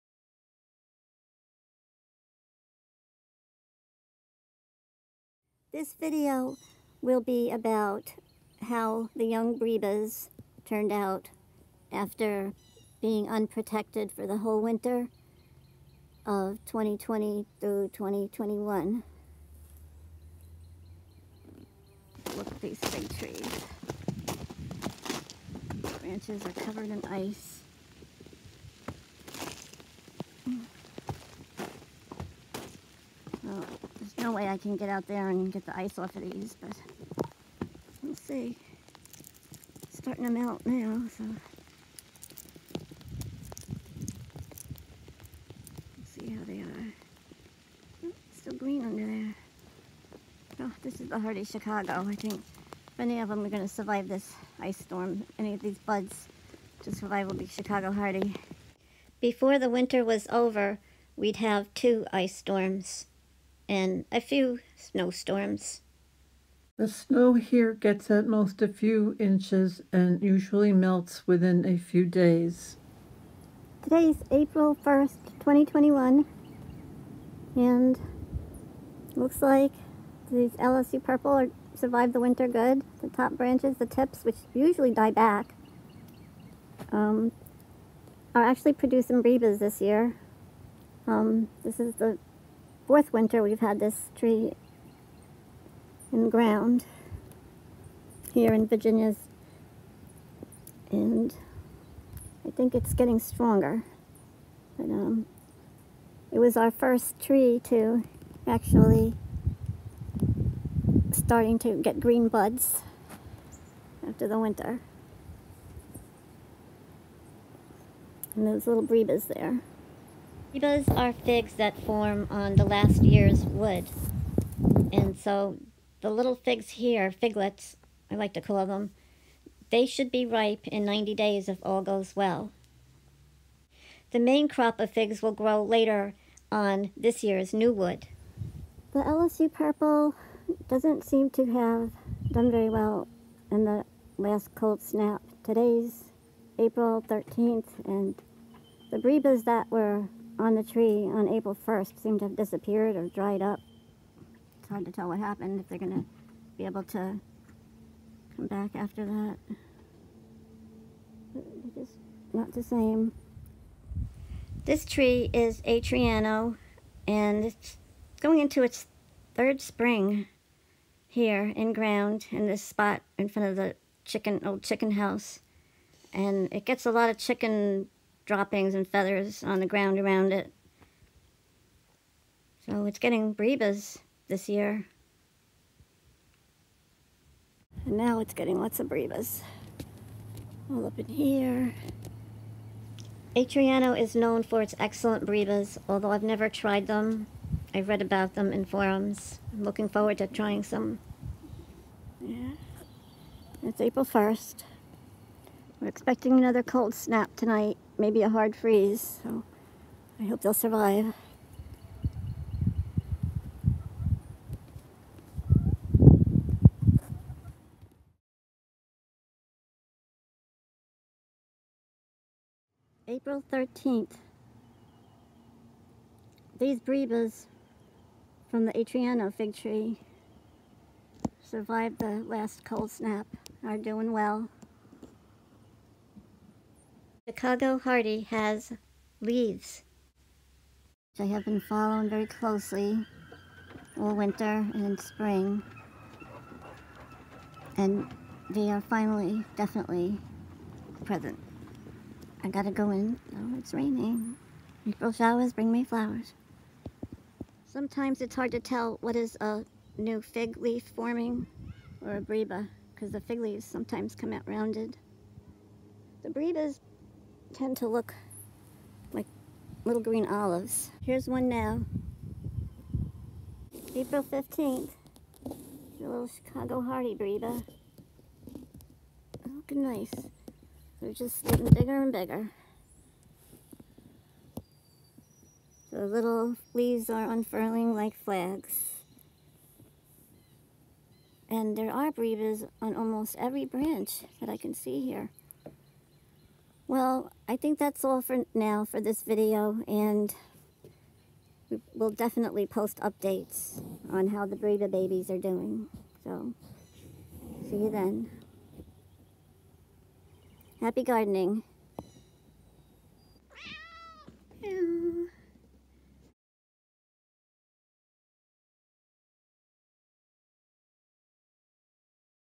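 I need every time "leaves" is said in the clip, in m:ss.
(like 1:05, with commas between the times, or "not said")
3:59, 4:23, 4:46.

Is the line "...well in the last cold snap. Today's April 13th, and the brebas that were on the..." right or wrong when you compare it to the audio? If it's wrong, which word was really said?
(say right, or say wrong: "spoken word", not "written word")
right.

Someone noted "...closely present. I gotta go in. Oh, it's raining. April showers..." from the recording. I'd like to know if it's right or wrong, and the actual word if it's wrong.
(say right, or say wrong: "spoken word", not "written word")
wrong: "definitely", not "closely".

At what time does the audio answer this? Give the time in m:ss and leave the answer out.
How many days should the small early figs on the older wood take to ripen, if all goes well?
2:10.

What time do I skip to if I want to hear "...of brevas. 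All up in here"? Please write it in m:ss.
3:08.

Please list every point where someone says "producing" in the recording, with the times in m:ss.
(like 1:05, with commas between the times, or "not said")
1:28.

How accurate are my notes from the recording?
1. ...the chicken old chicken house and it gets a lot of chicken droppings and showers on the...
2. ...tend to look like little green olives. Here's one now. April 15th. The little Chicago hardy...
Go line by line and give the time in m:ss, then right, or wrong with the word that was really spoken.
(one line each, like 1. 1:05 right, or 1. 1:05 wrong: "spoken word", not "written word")
1. 2:53 wrong: "feathers", not "showers"
2. 4:27 right.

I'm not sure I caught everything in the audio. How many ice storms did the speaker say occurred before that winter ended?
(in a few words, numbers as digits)
2.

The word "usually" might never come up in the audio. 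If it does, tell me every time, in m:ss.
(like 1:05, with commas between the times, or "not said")
1:10, 1:24.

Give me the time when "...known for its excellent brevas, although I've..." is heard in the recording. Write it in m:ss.
3:14.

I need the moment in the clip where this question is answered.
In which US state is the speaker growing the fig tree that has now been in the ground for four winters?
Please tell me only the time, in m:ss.
1:38.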